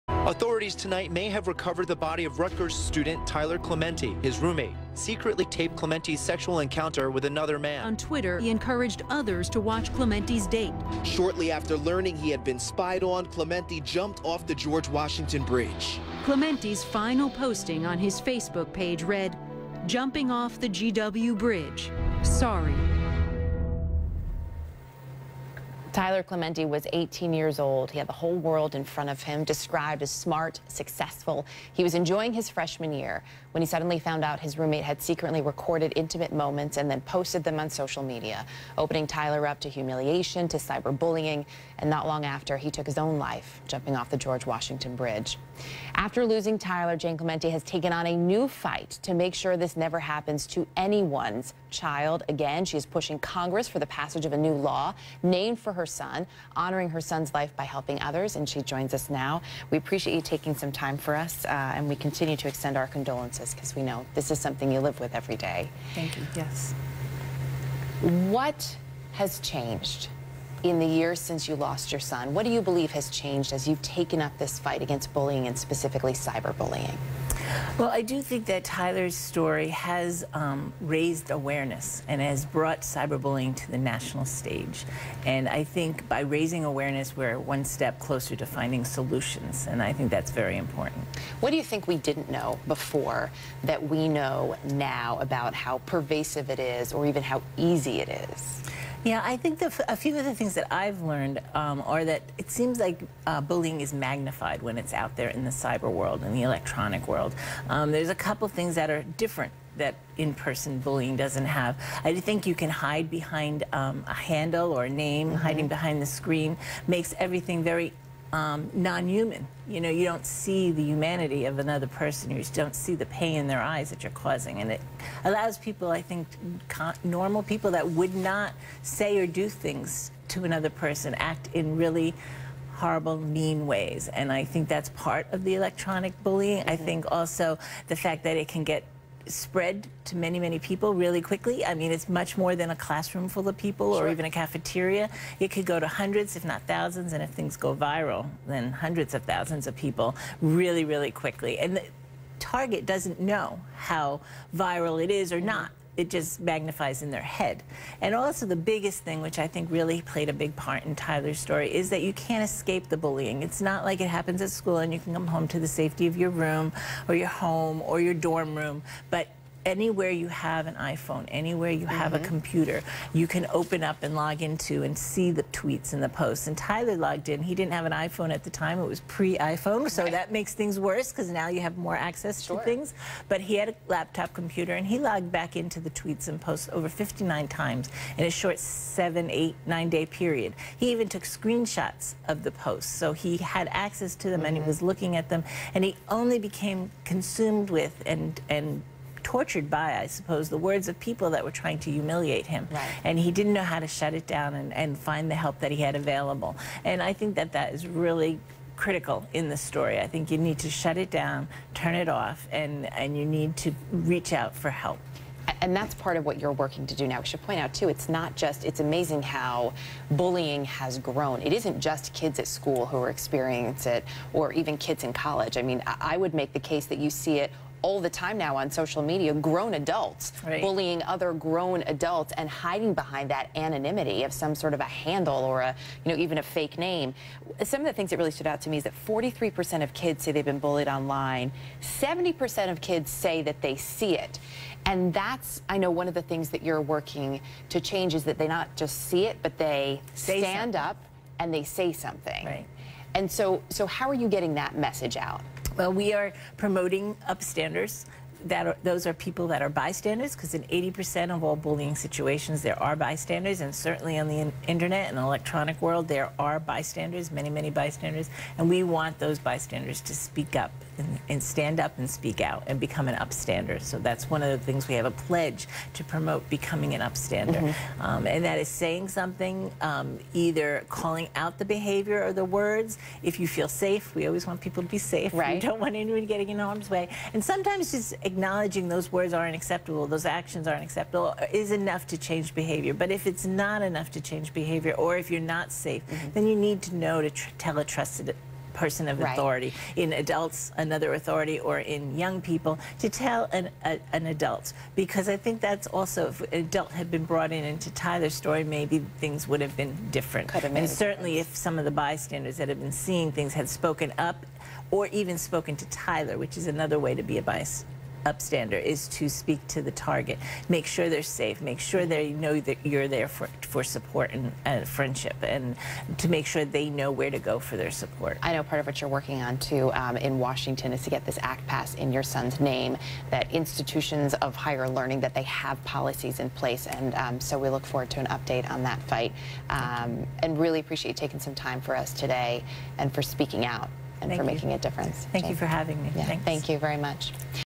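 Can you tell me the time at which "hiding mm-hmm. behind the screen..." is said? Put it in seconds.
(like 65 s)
115 s.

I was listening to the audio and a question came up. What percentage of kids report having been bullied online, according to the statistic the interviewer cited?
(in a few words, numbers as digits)
43%.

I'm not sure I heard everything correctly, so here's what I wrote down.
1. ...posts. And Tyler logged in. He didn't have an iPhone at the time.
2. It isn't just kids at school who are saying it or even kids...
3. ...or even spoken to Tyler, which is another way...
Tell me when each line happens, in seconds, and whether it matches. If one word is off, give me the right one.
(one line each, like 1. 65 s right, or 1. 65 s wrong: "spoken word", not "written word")
1. 176 s right
2. 221 s wrong: "experiencing", not "saying"
3. 314 s right.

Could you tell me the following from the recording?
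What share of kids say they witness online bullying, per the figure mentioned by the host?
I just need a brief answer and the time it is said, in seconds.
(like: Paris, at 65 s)
70%, at 241 s.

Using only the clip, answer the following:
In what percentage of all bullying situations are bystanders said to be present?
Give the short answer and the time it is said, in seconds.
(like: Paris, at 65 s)
80%, at 260 s.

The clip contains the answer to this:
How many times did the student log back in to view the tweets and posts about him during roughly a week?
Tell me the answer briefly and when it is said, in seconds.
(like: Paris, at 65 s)
59, at 186 s.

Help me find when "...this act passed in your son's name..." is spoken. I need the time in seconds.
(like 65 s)
331 s.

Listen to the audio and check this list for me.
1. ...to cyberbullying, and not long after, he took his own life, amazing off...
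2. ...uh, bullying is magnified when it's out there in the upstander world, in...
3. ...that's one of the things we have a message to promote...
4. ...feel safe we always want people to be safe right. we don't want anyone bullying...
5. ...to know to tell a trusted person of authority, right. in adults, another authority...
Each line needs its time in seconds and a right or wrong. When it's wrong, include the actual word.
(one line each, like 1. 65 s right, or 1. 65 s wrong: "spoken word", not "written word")
1. 40 s wrong: "jumping", not "amazing"
2. 103 s wrong: "cyber", not "upstander"
3. 273 s wrong: "pledge", not "message"
4. 283 s wrong: "getting", not "bullying"
5. 296 s right.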